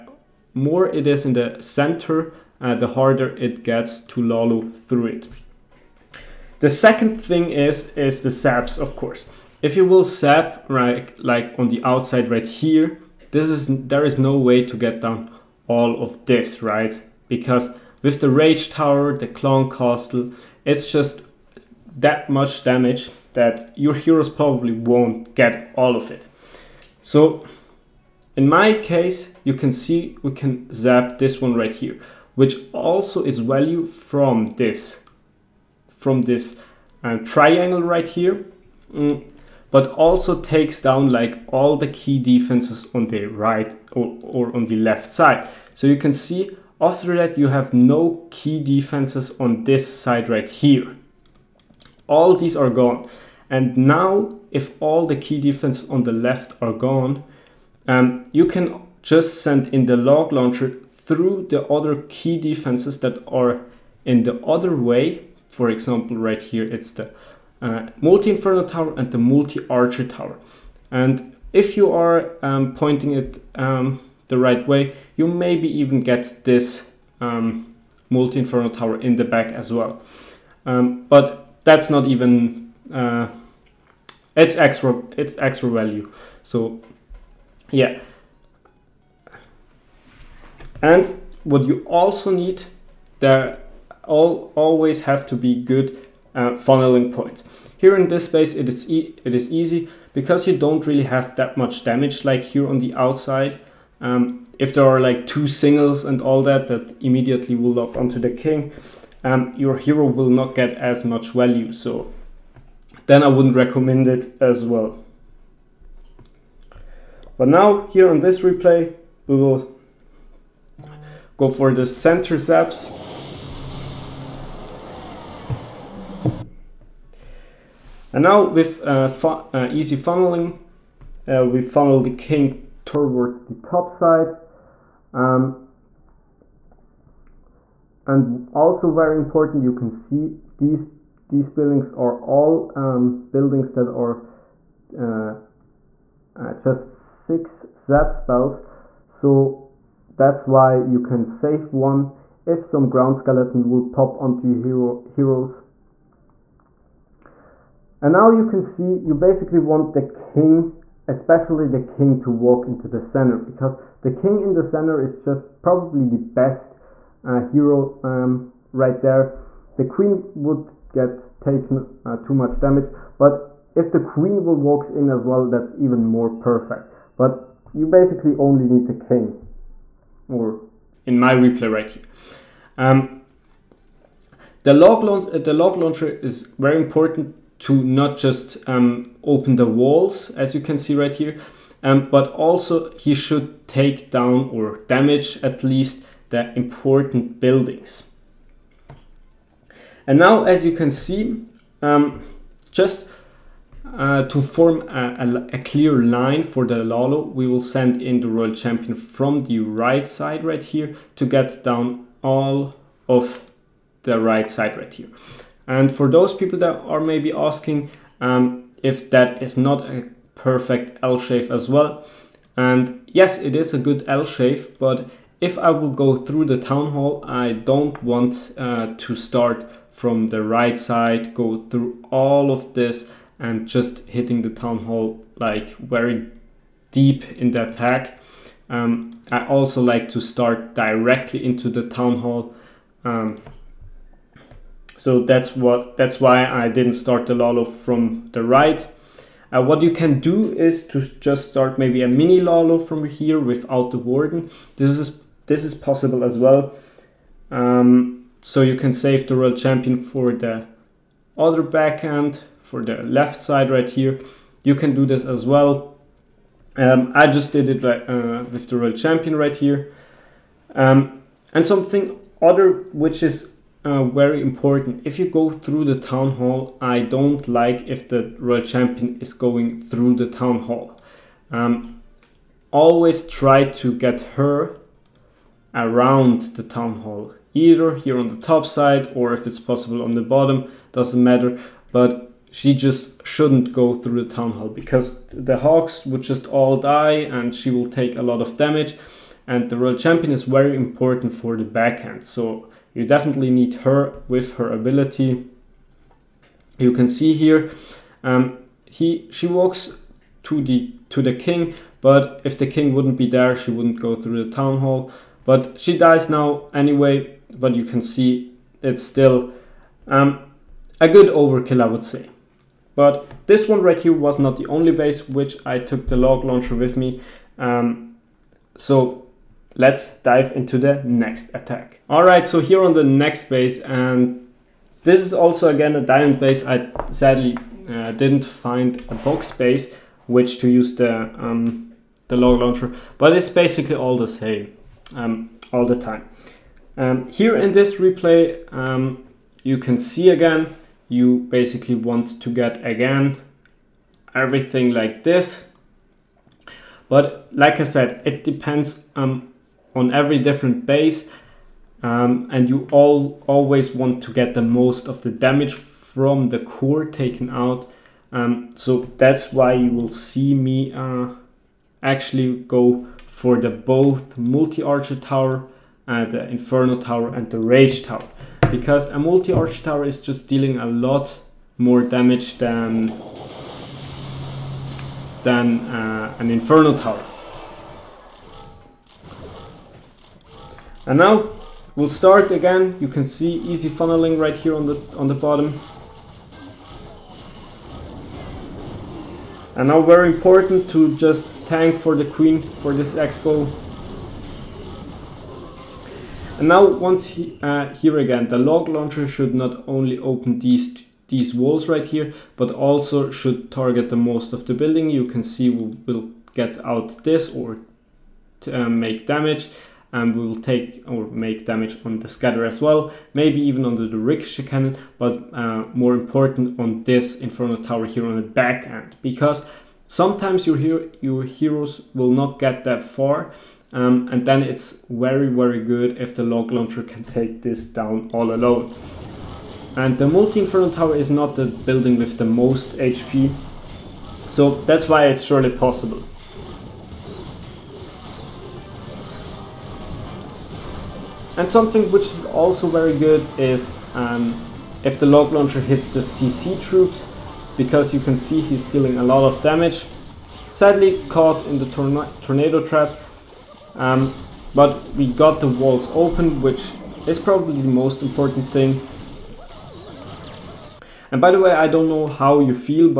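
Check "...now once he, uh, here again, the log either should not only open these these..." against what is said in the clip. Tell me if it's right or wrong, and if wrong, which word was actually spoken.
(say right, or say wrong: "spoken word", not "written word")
wrong: "launcher", not "either".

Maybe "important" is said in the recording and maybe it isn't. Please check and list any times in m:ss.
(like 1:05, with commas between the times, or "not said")
2:19, 3:06, 3:16, 4:34, 5:00, 6:40, 7:06, 7:48.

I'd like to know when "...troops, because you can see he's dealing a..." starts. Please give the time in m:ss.
7:36.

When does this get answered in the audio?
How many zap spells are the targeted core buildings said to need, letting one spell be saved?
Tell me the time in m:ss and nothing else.
2:27.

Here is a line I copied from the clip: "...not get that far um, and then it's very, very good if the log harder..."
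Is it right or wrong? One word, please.
wrong.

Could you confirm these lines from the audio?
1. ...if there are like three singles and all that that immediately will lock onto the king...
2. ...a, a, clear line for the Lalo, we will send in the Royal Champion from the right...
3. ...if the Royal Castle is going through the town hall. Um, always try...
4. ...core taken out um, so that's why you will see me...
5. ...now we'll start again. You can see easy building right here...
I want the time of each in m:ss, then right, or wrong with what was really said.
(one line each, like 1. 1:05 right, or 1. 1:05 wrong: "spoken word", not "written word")
1. 1:44 wrong: "two", not "three"
2. 3:25 right
3. 4:37 wrong: "Champion", not "Castle"
4. 6:06 right
5. 6:31 wrong: "funneling", not "building".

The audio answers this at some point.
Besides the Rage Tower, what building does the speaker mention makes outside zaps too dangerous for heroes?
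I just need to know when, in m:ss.
0:19.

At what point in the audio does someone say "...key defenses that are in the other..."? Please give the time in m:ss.
1:02.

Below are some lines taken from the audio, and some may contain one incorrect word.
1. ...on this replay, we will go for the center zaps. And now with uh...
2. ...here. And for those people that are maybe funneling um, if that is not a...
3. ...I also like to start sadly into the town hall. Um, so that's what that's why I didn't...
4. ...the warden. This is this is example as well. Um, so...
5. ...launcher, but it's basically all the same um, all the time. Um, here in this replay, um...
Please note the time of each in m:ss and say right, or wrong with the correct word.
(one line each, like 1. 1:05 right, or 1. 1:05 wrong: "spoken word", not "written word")
1. 1:58 right
2. 3:34 wrong: "asking", not "funneling"
3. 3:59 wrong: "directly", not "sadly"
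4. 4:13 wrong: "possible", not "example"
5. 5:42 right.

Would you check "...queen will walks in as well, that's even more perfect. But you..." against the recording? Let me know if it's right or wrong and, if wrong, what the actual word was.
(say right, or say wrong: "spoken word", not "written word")
right.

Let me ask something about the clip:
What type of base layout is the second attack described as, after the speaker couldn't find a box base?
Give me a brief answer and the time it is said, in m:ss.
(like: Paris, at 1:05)
Diamond base, at 5:36.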